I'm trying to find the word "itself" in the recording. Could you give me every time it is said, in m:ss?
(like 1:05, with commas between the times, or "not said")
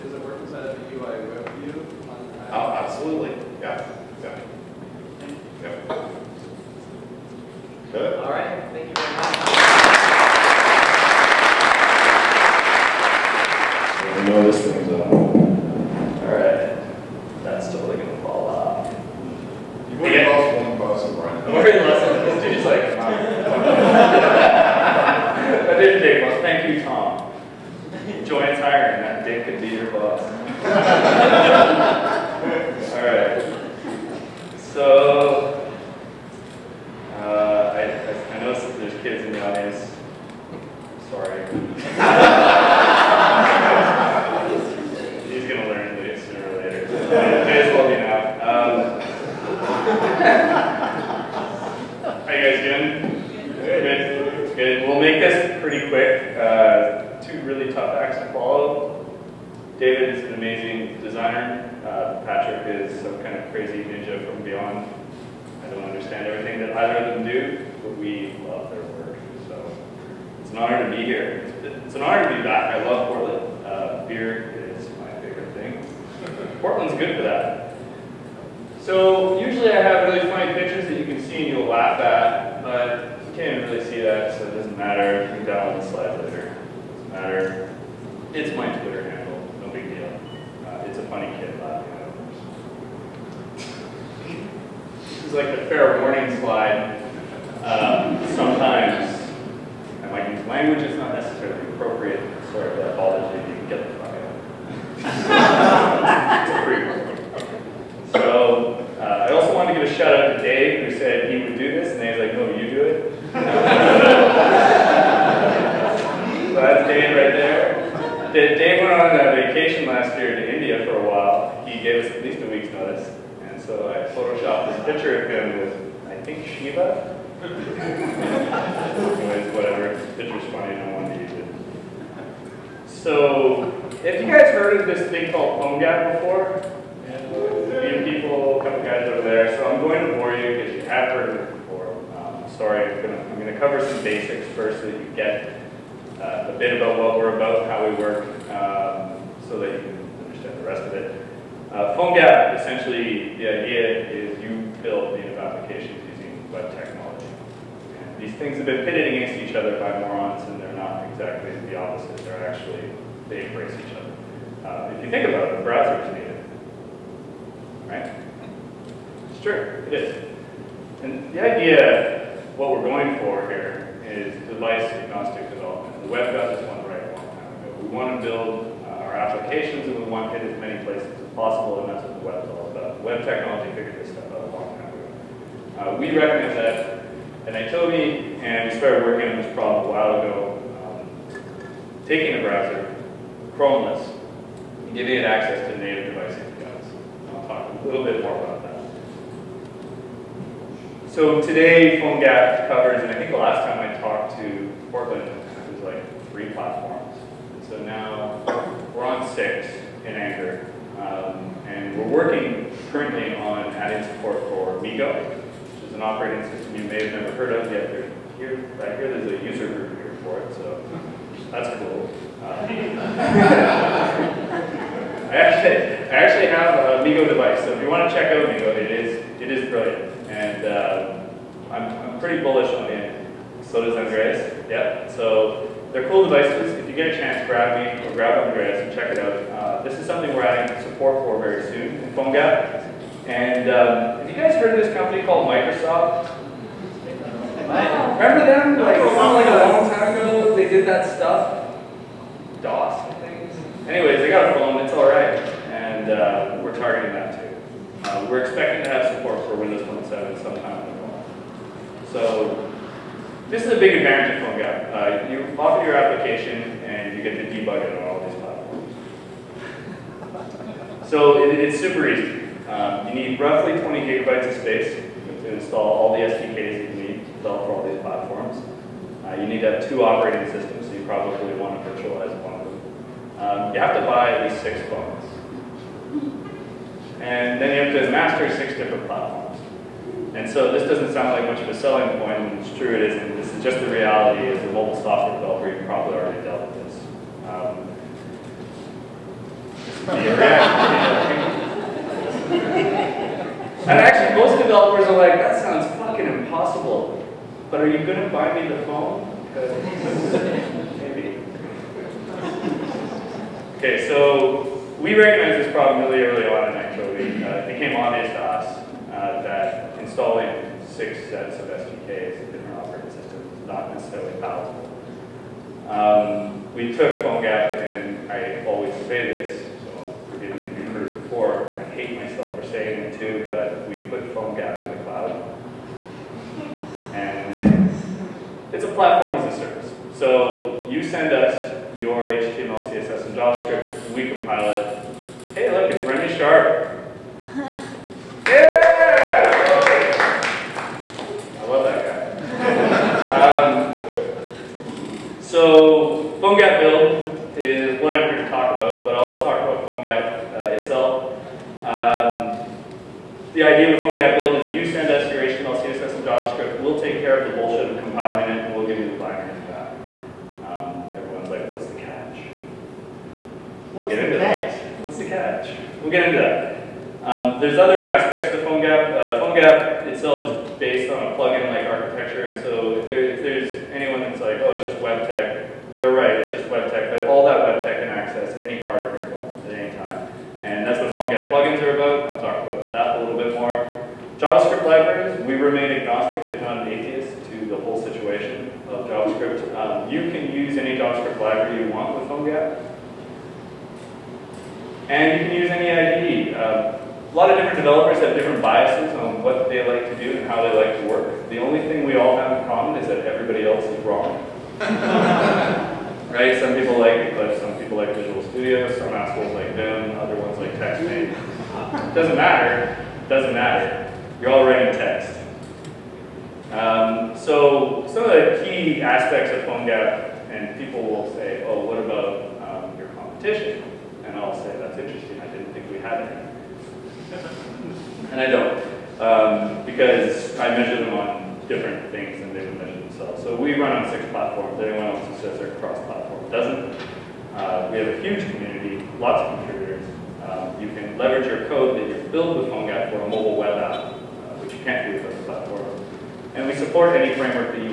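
6:00, 6:20.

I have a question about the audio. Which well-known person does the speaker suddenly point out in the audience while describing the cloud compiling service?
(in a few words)
Remy Sharp.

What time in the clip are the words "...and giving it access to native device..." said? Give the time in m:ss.
3:14.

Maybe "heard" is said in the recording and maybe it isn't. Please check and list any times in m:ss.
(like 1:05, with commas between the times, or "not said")
2:14, 2:21, 3:37, 4:04, 5:30.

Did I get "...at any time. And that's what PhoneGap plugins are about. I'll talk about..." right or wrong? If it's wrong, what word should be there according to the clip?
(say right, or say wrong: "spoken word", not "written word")
right.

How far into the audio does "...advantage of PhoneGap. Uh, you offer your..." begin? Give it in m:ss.
4:23.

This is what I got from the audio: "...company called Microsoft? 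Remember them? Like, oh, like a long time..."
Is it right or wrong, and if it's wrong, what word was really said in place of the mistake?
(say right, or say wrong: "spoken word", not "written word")
right.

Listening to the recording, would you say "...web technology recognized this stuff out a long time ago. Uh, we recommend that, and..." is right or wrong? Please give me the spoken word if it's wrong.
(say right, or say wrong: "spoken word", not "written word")
wrong: "figured", not "recognized".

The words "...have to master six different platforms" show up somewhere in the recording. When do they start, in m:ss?
4:47.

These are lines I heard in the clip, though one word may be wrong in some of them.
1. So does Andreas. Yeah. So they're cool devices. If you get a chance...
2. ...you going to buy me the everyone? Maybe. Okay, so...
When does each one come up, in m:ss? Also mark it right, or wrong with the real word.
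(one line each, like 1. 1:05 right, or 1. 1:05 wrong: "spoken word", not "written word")
1. 3:53 right
2. 5:07 wrong: "phone", not "everyone".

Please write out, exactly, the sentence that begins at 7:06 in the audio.
Um, so some of the key aspects of PhoneGap, and people will say, oh, what about um, your competition?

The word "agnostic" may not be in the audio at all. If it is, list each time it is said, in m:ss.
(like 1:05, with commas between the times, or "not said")
2:54, 6:35.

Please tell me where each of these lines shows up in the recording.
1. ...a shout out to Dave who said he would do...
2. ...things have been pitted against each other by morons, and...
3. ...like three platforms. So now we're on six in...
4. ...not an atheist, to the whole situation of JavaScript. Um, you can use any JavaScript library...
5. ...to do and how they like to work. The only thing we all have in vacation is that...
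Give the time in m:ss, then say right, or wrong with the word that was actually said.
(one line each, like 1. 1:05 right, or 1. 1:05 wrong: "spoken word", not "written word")
1. 1:49 right
2. 2:38 right
3. 3:25 right
4. 6:36 right
5. 6:50 wrong: "common", not "vacation".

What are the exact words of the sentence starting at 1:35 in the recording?
is like the fair warning slide.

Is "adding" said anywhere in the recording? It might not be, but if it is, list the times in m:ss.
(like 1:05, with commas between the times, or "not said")
3:33, 4:00.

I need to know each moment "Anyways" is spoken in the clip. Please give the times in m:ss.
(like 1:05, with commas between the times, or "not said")
2:07, 4:13.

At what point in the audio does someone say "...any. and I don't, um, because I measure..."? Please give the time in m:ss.
7:16.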